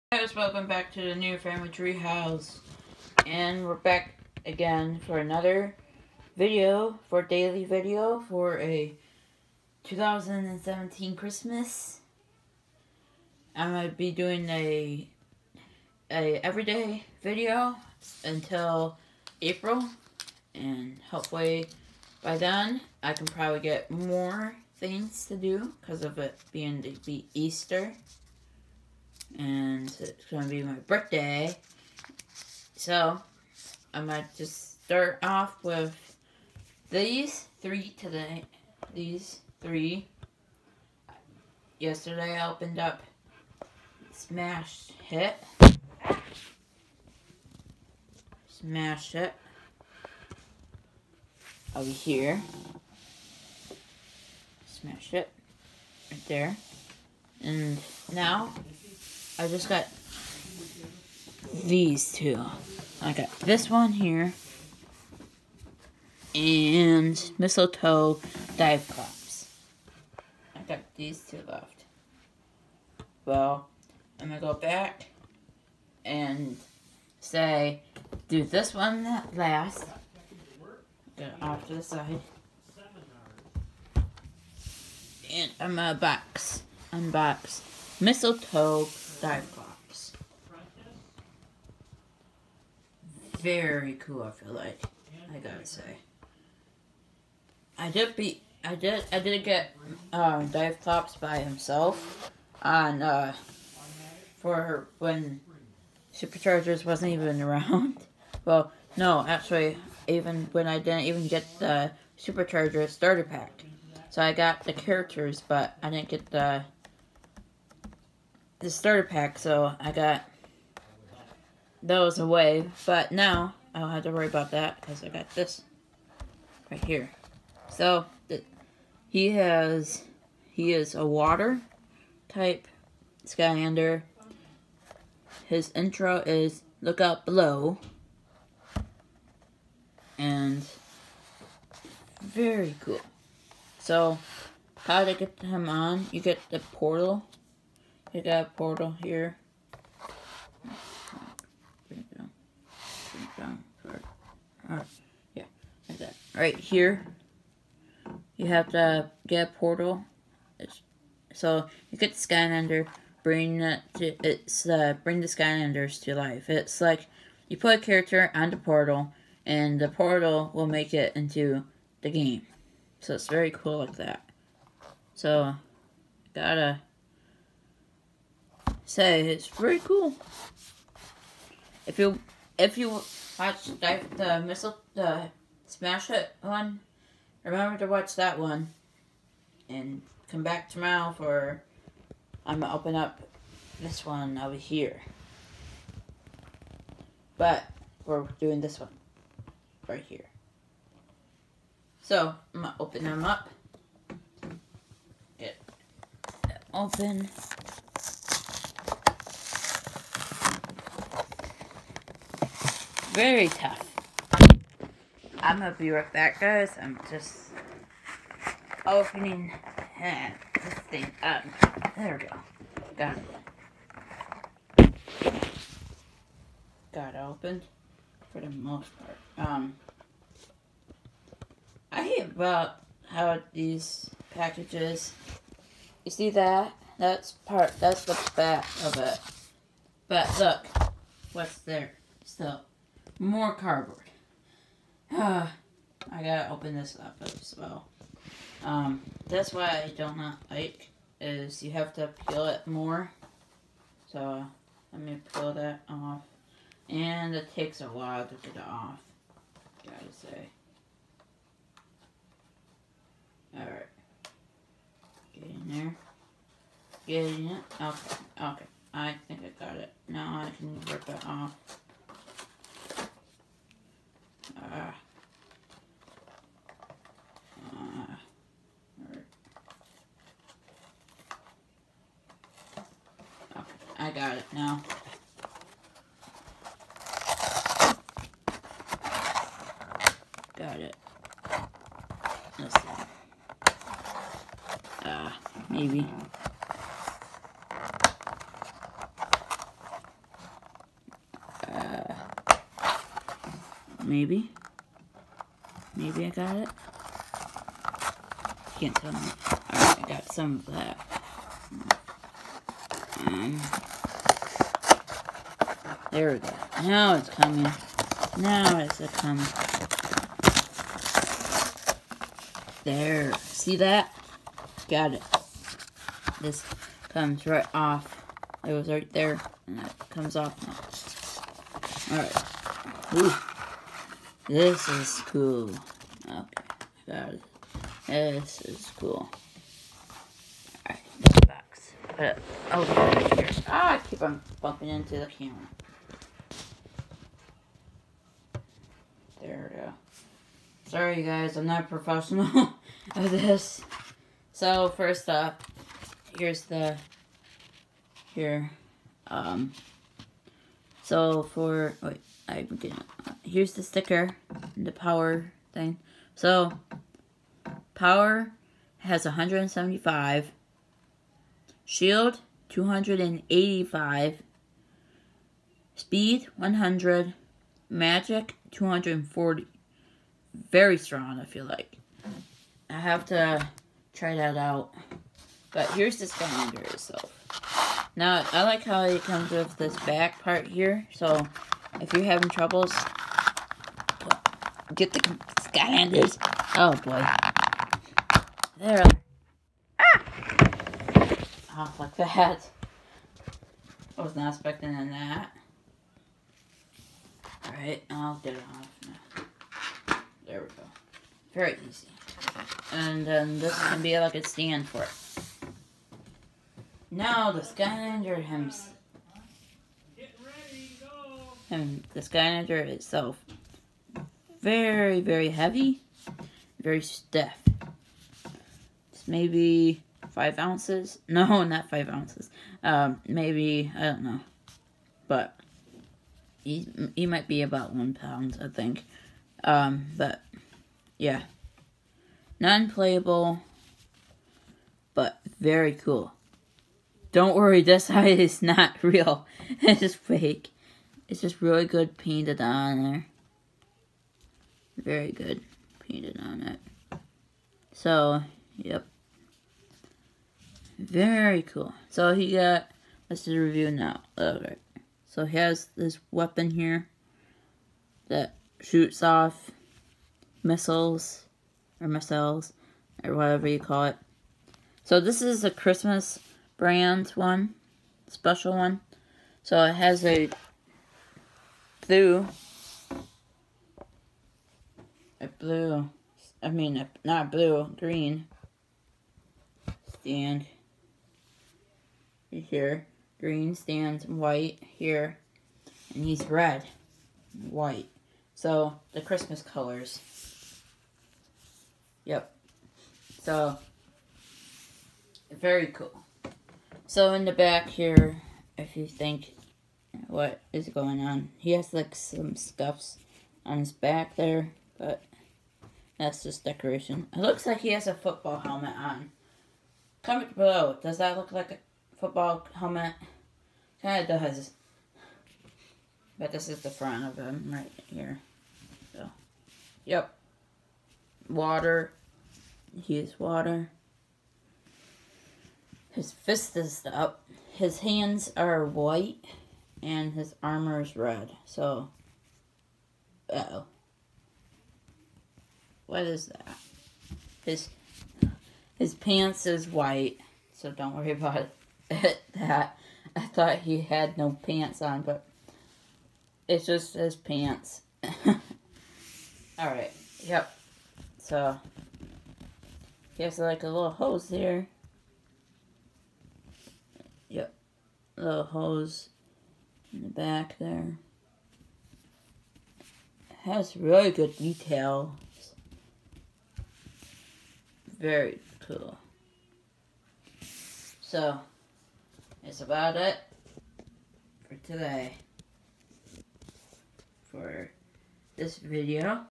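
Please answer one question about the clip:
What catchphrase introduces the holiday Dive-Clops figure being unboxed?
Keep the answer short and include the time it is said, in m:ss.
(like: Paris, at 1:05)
Look Out Below, at 2:16.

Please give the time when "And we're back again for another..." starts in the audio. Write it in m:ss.
0:03.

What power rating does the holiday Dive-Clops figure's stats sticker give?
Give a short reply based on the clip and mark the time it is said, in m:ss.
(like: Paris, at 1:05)
175, at 6:09.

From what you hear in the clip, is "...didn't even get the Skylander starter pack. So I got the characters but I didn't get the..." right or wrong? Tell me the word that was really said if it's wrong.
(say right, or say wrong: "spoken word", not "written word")
wrong: "Supercharger", not "Skylander".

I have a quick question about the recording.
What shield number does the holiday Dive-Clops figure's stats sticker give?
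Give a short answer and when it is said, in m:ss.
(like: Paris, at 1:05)
285, at 6:11.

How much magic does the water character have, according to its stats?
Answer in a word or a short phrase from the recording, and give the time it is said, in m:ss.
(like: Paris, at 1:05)
240, at 6:17.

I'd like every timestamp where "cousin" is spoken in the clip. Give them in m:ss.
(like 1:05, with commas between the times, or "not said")
not said.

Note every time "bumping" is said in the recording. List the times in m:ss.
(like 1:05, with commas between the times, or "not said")
5:44.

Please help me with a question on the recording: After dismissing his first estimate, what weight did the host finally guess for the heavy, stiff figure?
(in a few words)
1 pound.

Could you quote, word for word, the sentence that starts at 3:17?
But we're doing this one right here.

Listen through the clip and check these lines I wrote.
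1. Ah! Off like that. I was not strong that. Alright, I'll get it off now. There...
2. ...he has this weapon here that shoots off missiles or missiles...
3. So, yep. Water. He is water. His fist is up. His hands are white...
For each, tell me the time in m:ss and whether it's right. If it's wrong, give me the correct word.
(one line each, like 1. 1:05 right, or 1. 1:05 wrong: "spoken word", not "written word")
1. 6:39 wrong: "expecting", not "strong"
2. 7:45 right
3. 8:49 right.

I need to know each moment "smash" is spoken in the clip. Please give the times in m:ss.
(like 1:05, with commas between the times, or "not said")
0:44, 0:48, 0:54, 3:05.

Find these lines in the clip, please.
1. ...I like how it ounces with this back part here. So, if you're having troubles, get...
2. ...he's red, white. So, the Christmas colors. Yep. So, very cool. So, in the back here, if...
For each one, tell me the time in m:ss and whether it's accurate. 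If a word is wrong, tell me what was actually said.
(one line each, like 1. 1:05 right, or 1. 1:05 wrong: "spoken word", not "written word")
1. 6:28 wrong: "comes", not "ounces"
2. 8:16 right.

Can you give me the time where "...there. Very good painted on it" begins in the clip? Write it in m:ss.
7:33.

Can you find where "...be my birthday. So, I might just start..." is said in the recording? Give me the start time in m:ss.
0:30.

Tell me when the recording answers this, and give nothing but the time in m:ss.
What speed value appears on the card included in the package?
6:15.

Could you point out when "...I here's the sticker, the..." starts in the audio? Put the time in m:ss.
6:02.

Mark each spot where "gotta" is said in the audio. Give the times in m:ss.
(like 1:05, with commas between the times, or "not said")
1:35, 2:56, 4:06, 4:19.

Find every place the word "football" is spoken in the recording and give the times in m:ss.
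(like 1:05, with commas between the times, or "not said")
8:38, 8:42.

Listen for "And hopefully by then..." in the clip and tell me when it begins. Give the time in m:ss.
0:20.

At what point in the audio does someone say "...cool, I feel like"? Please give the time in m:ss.
1:33.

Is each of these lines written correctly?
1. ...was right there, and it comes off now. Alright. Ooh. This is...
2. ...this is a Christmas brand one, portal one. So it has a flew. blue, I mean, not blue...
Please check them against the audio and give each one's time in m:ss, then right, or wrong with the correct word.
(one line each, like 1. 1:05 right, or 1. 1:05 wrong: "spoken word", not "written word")
1. 5:28 right
2. 7:55 wrong: "special", not "portal".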